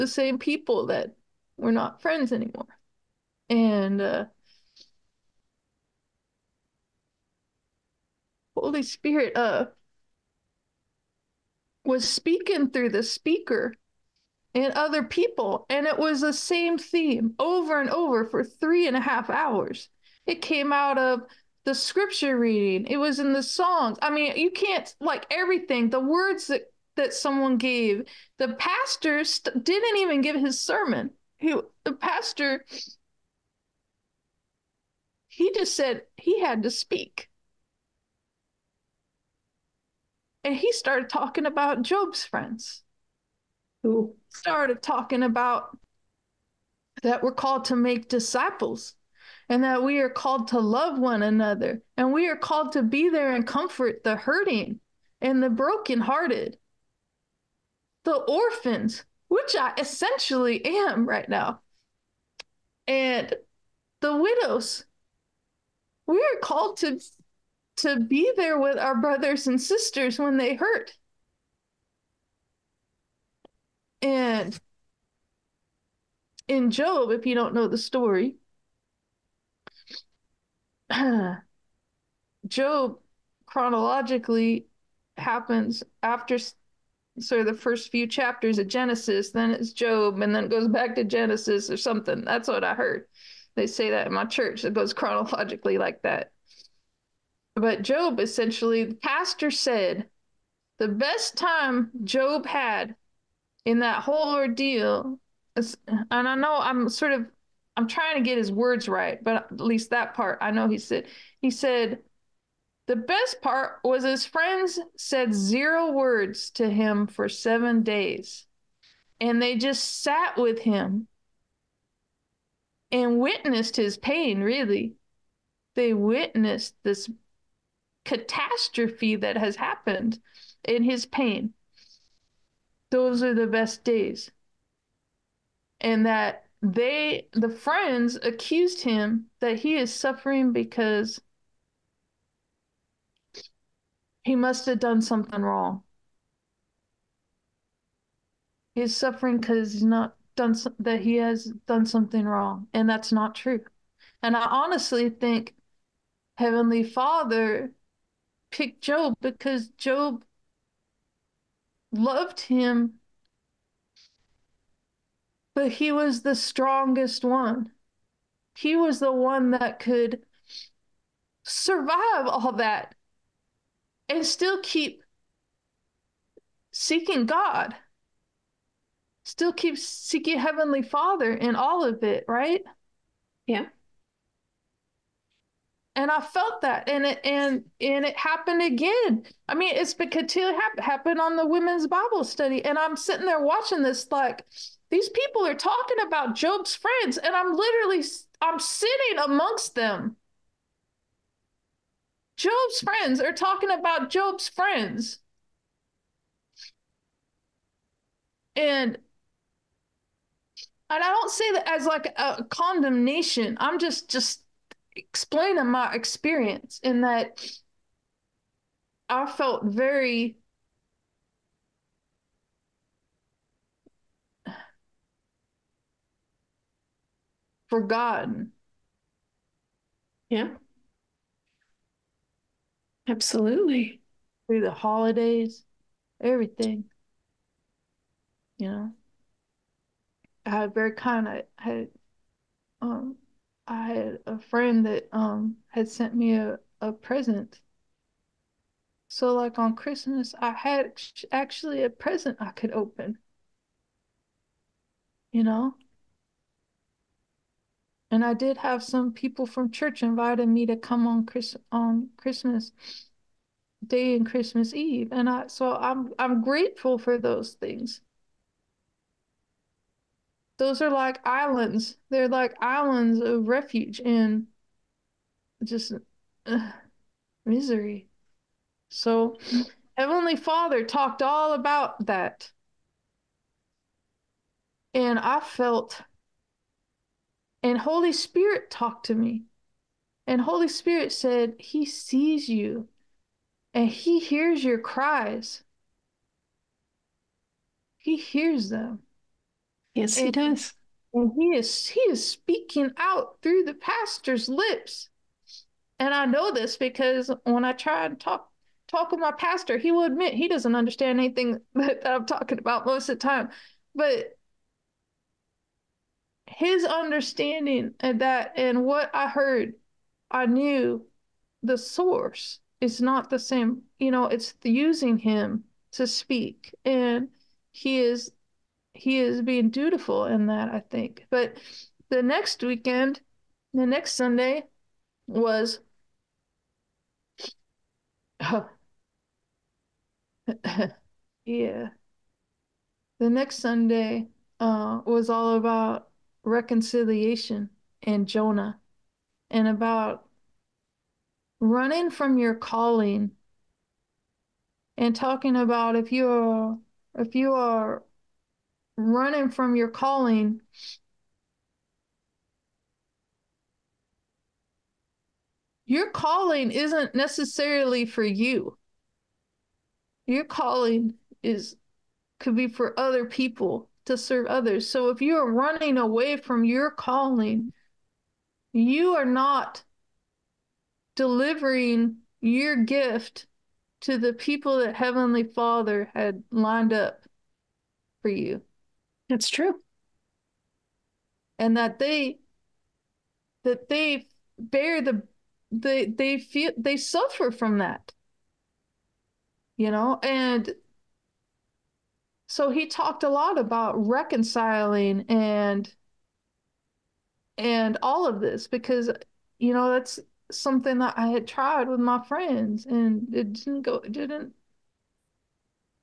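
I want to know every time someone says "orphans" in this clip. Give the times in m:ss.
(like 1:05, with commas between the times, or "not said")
0:58.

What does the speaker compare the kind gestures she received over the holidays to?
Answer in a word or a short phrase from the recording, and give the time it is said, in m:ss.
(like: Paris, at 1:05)
islands of refuge, at 4:32.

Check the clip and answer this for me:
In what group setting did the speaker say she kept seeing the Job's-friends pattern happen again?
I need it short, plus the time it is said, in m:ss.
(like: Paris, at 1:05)
women's Bible study, at 3:11.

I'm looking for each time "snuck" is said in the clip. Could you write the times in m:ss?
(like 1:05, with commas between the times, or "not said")
not said.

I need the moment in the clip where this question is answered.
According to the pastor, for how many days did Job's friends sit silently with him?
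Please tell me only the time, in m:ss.
1:57.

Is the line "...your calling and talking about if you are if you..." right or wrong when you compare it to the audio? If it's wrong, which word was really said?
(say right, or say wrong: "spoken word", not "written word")
right.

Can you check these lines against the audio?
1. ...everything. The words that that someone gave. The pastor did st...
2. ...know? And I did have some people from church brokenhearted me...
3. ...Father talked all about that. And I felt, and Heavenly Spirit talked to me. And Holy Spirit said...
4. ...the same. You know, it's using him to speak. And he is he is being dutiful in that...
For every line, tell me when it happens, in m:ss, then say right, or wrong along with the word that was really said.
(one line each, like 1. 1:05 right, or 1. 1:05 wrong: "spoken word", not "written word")
1. 0:25 right
2. 4:15 wrong: "invited", not "brokenhearted"
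3. 4:40 wrong: "Holy", not "Heavenly"
4. 5:23 right.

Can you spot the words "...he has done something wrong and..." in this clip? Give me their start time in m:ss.
2:30.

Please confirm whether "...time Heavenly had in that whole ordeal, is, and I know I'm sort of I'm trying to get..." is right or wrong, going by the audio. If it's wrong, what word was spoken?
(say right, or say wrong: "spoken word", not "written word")
wrong: "Job", not "Heavenly".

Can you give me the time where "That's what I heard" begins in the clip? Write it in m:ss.
1:32.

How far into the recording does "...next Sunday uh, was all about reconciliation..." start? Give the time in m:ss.
5:43.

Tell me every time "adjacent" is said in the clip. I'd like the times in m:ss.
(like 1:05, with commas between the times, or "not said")
not said.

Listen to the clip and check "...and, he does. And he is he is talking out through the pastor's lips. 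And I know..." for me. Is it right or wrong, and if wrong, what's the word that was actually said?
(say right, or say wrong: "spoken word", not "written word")
wrong: "speaking", not "talking".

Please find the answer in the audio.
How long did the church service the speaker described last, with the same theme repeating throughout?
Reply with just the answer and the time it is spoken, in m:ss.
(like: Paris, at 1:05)
3.5 hours, at 0:18.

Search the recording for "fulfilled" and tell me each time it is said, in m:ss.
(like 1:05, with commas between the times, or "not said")
not said.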